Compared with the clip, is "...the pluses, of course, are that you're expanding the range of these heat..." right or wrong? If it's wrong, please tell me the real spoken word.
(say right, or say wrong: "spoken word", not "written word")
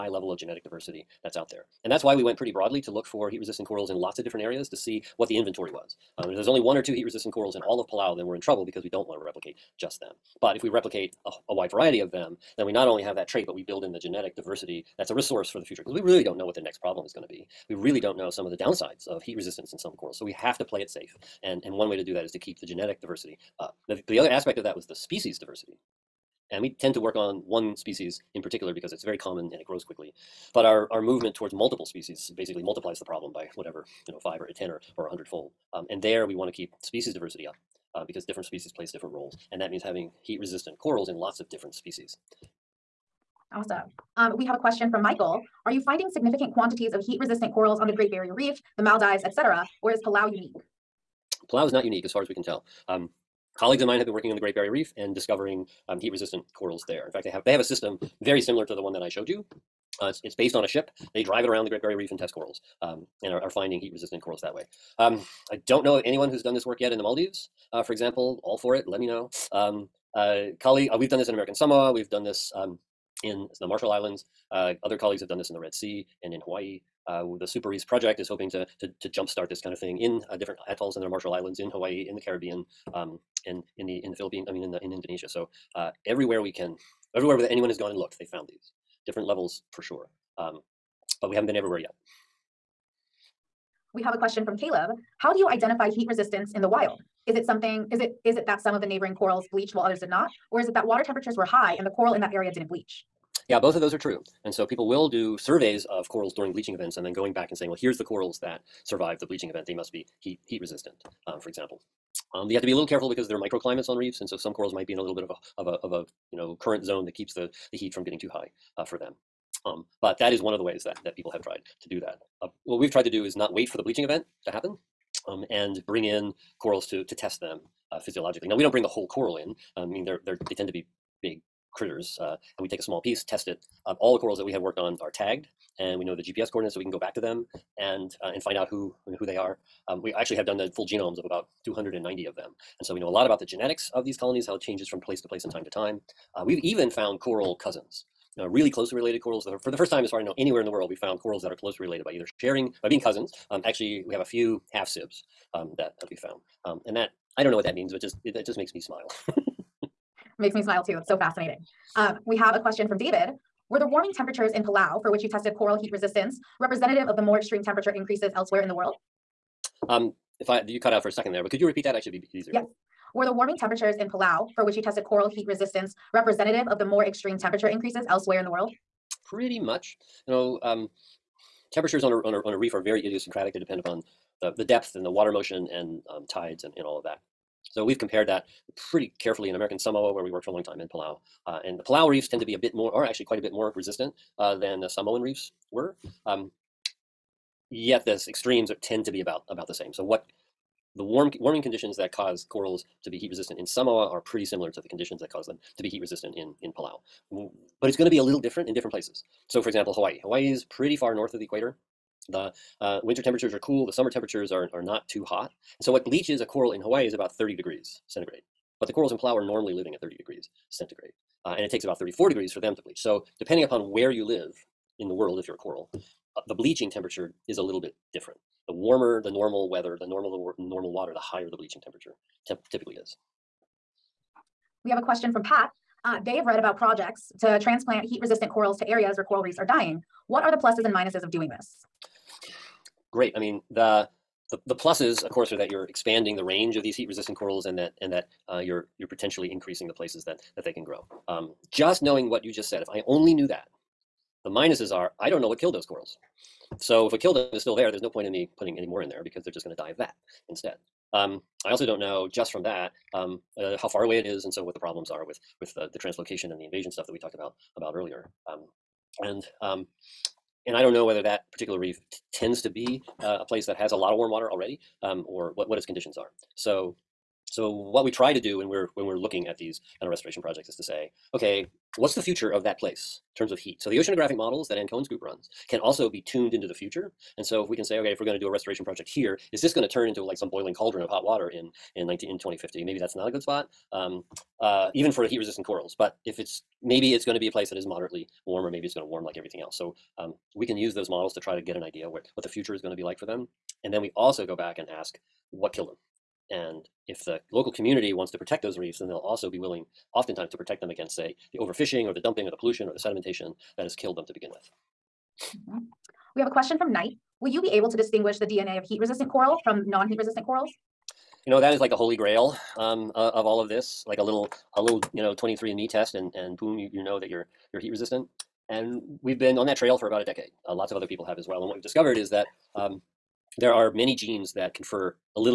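right.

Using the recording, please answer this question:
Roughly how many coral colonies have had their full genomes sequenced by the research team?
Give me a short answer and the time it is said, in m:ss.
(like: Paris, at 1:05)
290, at 2:21.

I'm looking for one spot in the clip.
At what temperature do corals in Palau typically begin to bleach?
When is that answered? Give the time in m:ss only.
3:41.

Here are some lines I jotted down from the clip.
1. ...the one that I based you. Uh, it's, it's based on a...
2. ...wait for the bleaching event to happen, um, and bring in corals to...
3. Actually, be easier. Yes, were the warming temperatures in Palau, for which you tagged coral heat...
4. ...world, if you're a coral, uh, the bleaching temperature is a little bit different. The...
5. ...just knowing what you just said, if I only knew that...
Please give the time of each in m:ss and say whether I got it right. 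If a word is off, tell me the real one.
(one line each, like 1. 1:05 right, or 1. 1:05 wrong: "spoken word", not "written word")
1. 0:58 wrong: "showed", not "based"
2. 2:03 right
3. 2:51 wrong: "tested", not "tagged"
4. 3:45 right
5. 4:11 right.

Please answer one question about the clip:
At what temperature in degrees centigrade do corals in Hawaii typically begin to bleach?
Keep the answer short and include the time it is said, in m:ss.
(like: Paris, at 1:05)
30 degrees, at 3:37.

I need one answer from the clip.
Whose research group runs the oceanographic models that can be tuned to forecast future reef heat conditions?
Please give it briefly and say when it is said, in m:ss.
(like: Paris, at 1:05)
Anne Cohen, at 4:44.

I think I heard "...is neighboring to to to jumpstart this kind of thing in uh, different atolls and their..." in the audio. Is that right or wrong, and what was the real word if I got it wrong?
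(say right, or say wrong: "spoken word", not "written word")
wrong: "hoping", not "neighboring".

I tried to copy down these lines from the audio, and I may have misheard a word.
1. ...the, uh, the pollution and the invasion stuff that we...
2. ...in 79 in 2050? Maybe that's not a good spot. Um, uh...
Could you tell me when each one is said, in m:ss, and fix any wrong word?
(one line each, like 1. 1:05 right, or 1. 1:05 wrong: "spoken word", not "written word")
1. 4:25 wrong: "translocation", not "pollution"
2. 4:51 wrong: "19", not "79".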